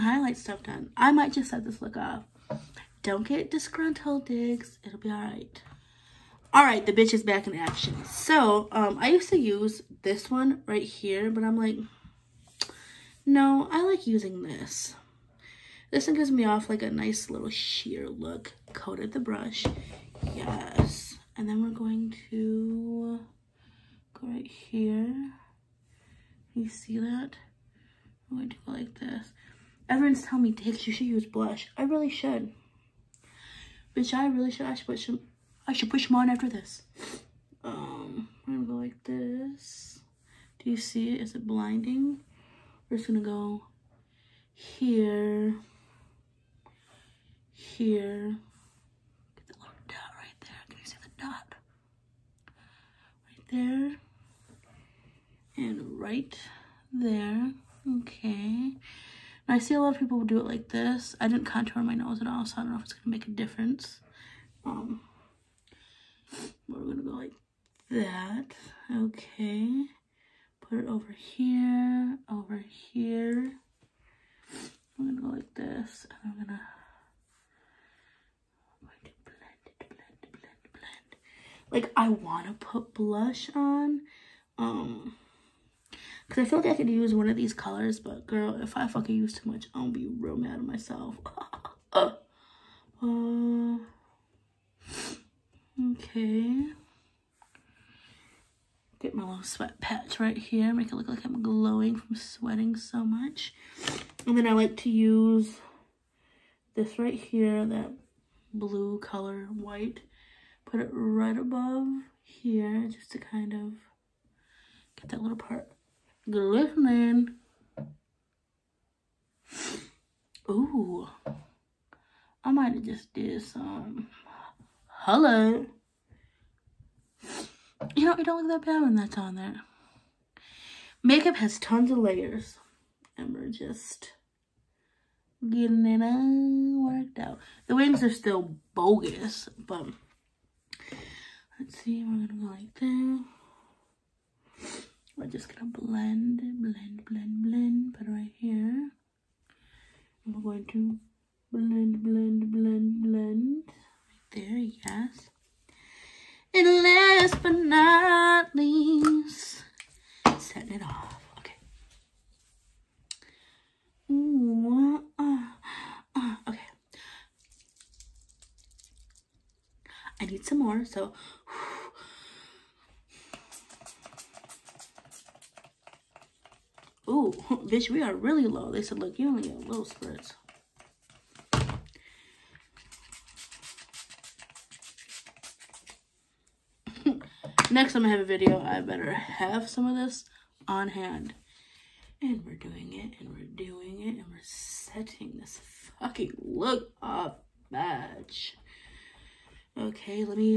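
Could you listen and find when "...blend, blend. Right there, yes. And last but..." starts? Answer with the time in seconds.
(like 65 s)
152 s.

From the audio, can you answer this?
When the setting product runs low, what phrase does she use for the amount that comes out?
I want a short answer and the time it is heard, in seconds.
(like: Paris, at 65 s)
little spritz, at 179 s.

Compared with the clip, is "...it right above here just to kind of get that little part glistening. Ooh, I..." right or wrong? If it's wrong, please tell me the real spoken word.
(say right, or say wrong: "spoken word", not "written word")
right.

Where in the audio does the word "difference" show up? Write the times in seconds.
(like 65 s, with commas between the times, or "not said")
63 s.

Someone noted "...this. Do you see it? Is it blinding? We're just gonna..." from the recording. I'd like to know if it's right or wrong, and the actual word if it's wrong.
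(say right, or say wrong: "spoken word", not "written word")
right.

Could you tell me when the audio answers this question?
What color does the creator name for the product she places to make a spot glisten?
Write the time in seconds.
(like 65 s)
107 s.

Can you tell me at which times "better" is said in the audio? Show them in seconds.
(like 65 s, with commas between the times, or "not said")
188 s.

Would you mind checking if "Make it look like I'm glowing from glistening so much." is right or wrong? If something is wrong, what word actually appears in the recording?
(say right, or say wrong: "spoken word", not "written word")
wrong: "sweating", not "glistening".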